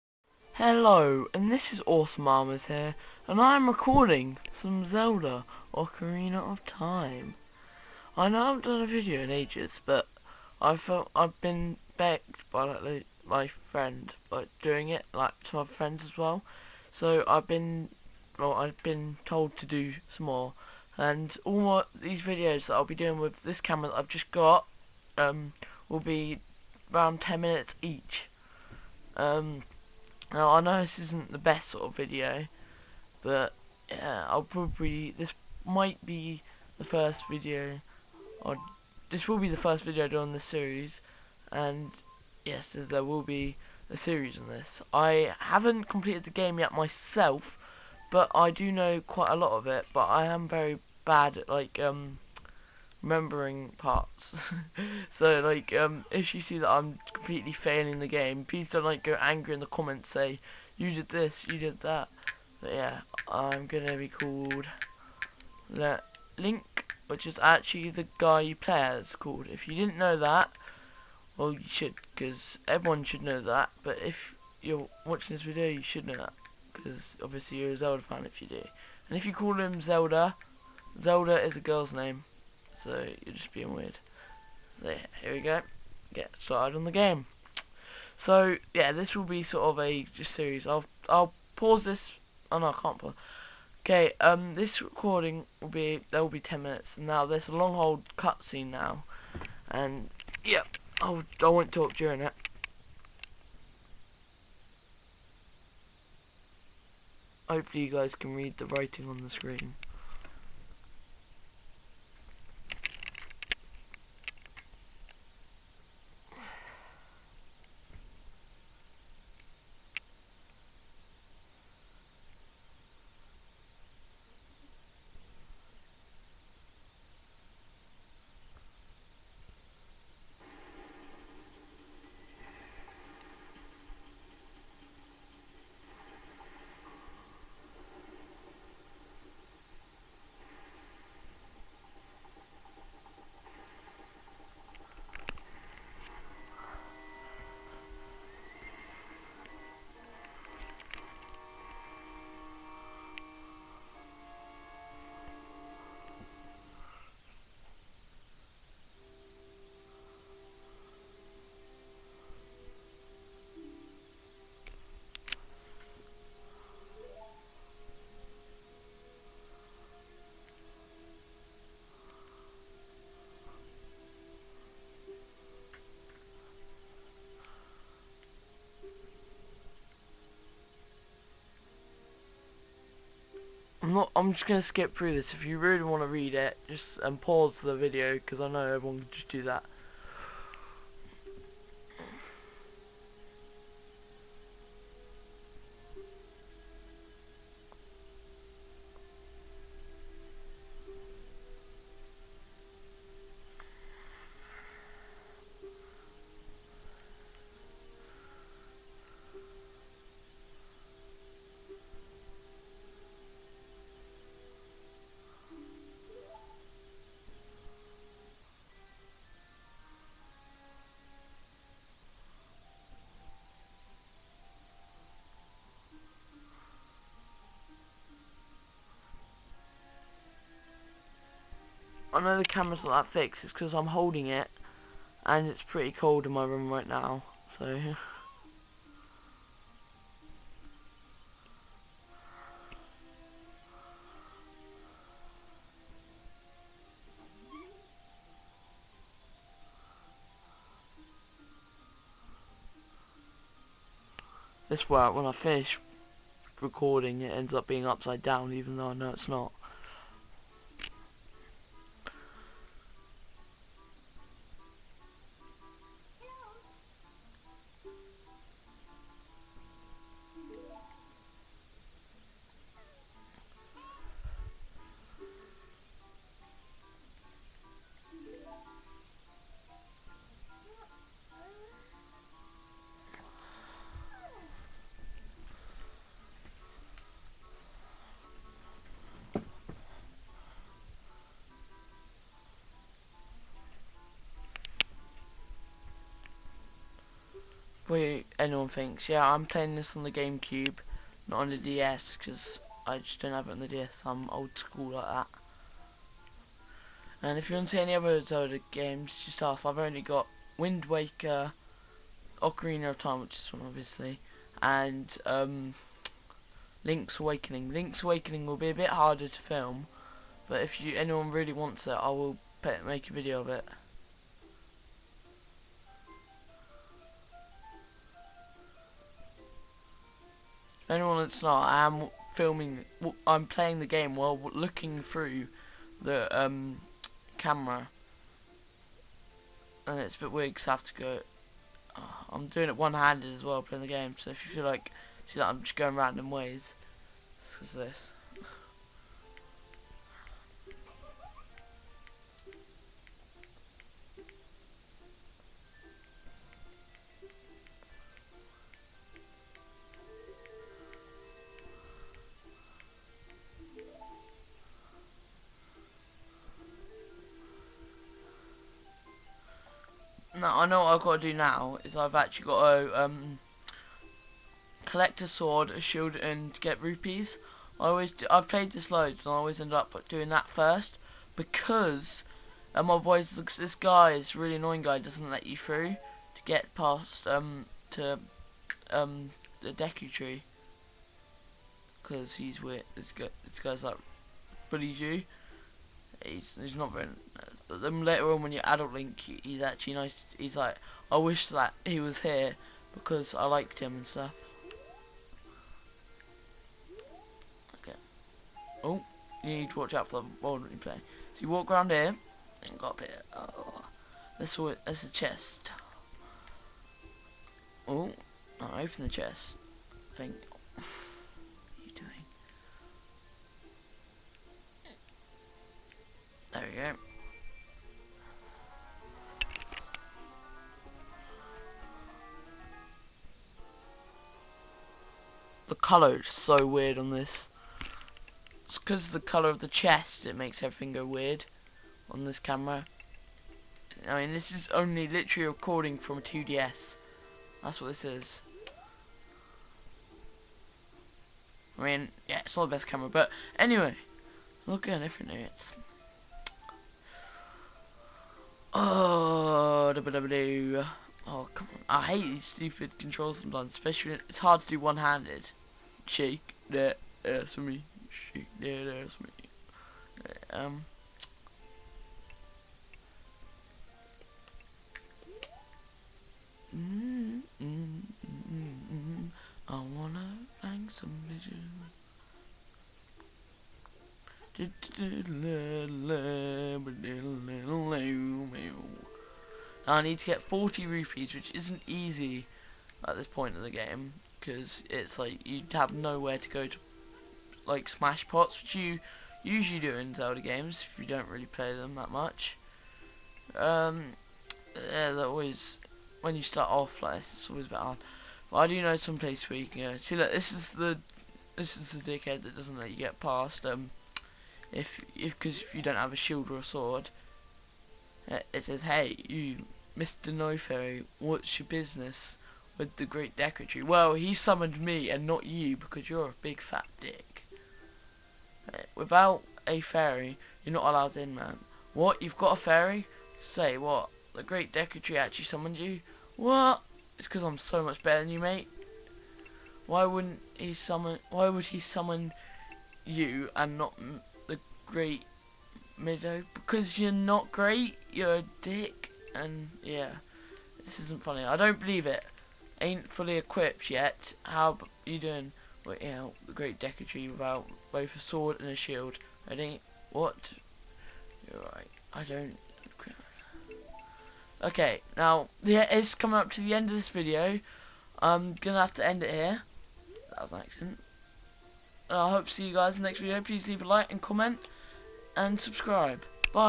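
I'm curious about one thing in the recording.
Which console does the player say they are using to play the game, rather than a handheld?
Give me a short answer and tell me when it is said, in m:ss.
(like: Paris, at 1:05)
GameCube, at 5:00.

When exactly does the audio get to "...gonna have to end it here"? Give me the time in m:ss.
9:28.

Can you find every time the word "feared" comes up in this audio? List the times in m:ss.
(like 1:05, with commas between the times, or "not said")
not said.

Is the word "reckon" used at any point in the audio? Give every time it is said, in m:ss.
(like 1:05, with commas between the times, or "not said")
not said.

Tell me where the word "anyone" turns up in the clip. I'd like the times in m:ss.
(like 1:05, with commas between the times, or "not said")
4:58, 5:20, 5:30.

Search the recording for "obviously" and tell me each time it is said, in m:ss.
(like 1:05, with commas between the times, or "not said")
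1:17, 5:13.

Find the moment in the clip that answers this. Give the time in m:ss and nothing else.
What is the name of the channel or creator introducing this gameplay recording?
0:01.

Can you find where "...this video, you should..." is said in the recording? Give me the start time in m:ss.
1:15.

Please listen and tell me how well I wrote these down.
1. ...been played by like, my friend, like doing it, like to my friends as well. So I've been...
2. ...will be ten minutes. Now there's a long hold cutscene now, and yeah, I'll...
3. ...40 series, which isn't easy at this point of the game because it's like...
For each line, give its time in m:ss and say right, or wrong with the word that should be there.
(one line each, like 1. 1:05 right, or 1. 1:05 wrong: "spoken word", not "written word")
1. 0:11 wrong: "begged", not "played"
2. 1:36 right
3. 8:10 wrong: "rupees", not "series".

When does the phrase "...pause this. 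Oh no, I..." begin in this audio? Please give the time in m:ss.
1:31.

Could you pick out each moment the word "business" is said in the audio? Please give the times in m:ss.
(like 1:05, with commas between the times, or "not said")
8:41.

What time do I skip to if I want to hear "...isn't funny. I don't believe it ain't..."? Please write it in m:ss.
9:11.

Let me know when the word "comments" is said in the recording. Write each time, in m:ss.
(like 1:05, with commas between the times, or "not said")
0:59, 9:34.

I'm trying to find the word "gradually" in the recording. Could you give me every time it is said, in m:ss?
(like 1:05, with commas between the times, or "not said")
not said.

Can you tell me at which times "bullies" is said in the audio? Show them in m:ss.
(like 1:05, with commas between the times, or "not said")
6:34.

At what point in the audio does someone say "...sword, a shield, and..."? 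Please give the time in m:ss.
6:15.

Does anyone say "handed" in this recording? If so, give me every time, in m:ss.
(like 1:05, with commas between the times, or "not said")
5:42, 7:44.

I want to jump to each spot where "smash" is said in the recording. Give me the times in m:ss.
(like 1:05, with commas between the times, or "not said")
8:17.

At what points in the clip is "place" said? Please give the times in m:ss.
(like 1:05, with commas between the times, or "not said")
8:29.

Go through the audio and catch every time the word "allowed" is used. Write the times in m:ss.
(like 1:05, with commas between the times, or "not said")
8:50.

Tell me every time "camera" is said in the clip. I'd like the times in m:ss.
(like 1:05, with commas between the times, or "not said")
0:23, 3:52, 5:37, 7:22, 7:32.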